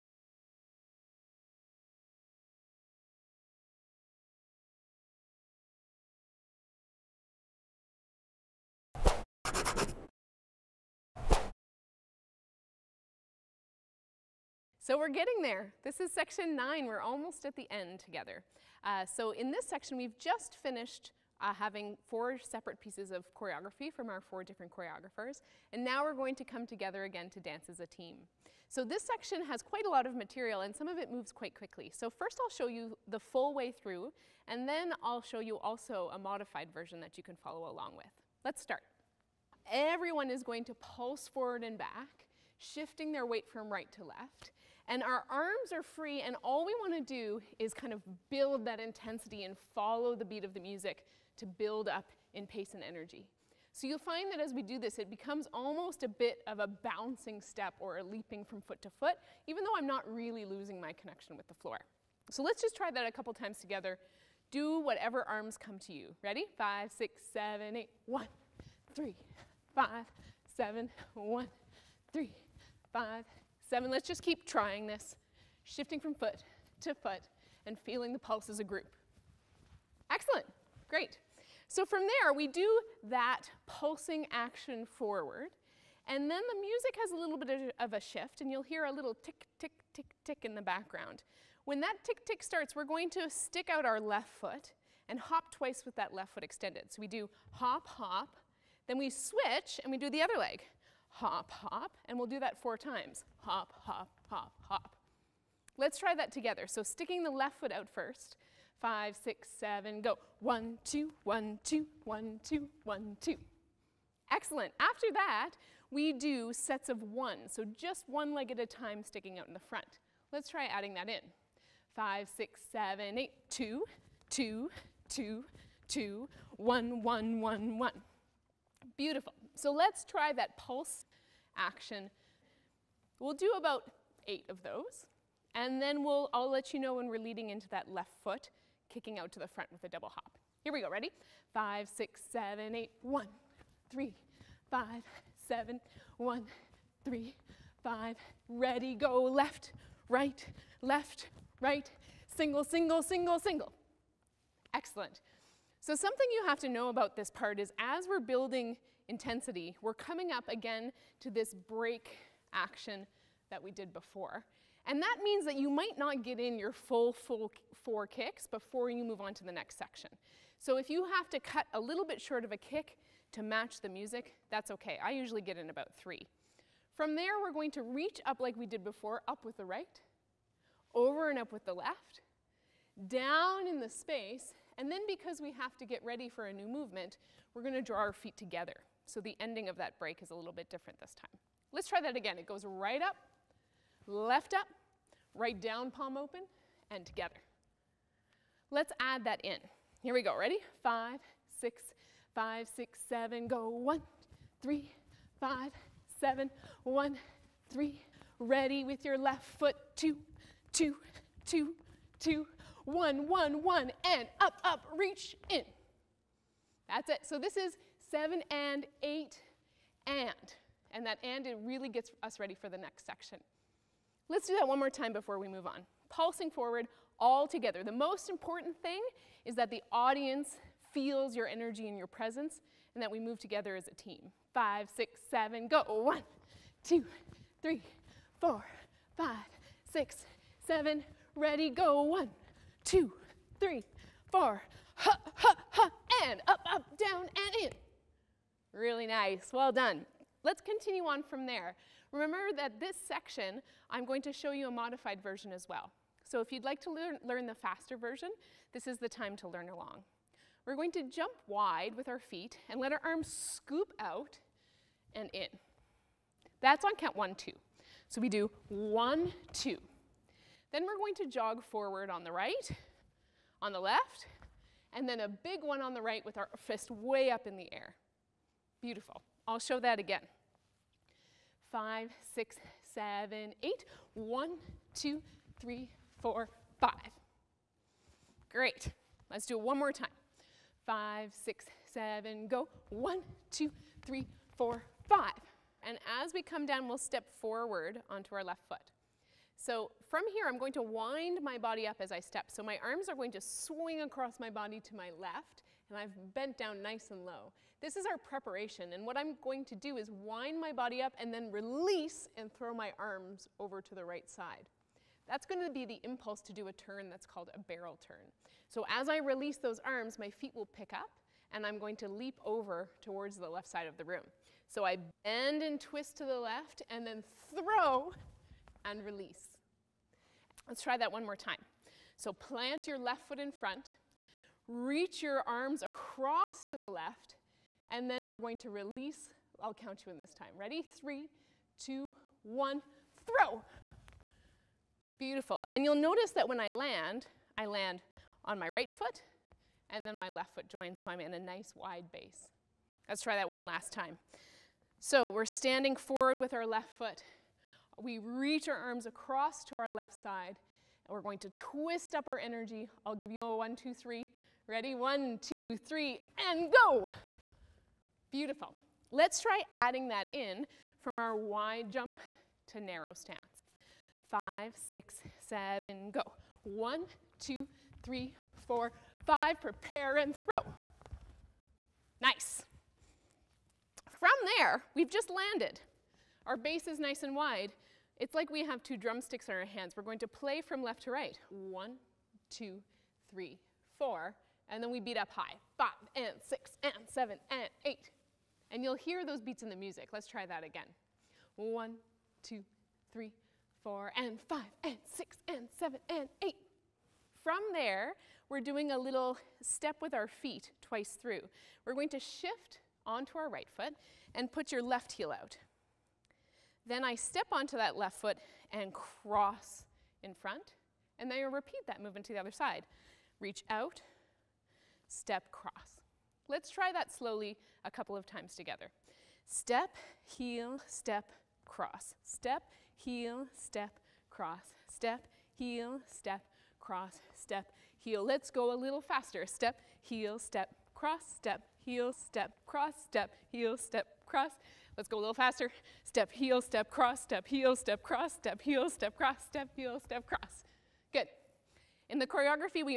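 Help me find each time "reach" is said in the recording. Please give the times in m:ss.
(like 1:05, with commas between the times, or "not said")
2:57, 3:34, 5:34, 5:58, 7:03.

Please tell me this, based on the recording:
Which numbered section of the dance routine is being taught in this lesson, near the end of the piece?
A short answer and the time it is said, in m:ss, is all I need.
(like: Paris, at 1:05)
9, at 0:16.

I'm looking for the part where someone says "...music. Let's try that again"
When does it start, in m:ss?
6:39.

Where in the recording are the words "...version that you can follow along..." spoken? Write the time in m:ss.
0:36.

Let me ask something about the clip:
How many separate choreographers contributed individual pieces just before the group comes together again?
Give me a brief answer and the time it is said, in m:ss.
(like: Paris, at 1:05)
4, at 0:24.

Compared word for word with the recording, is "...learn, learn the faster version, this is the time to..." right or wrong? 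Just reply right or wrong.
right.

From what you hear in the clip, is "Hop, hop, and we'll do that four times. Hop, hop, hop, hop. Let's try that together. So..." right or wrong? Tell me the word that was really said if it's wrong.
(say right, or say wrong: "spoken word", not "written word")
right.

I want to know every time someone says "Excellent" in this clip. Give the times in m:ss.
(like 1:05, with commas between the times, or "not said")
1:20, 1:54, 2:34.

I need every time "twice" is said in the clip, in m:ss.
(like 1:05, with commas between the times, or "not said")
1:35, 6:50.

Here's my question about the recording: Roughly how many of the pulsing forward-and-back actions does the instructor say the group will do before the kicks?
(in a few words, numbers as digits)
8.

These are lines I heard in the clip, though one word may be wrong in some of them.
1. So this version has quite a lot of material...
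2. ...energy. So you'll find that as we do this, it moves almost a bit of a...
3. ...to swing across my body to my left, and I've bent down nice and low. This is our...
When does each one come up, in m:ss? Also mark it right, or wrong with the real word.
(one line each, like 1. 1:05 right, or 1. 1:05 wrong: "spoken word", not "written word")
1. 0:28 wrong: "section", not "version"
2. 0:52 wrong: "becomes", not "moves"
3. 5:03 right.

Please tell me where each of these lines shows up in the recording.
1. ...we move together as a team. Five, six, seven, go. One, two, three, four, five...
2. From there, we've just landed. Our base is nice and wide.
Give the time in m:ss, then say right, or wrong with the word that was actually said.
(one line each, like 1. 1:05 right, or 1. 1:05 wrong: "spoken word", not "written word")
1. 3:53 right
2. 6:24 right.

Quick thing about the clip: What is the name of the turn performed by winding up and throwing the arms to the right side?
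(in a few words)
Barrel turn.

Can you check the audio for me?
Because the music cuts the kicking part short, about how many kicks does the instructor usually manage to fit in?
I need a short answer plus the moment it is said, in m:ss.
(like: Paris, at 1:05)
3, at 2:55.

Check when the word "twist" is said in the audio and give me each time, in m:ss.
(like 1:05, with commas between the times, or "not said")
5:25, 6:01.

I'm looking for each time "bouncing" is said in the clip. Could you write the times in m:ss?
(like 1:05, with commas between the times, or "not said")
0:56.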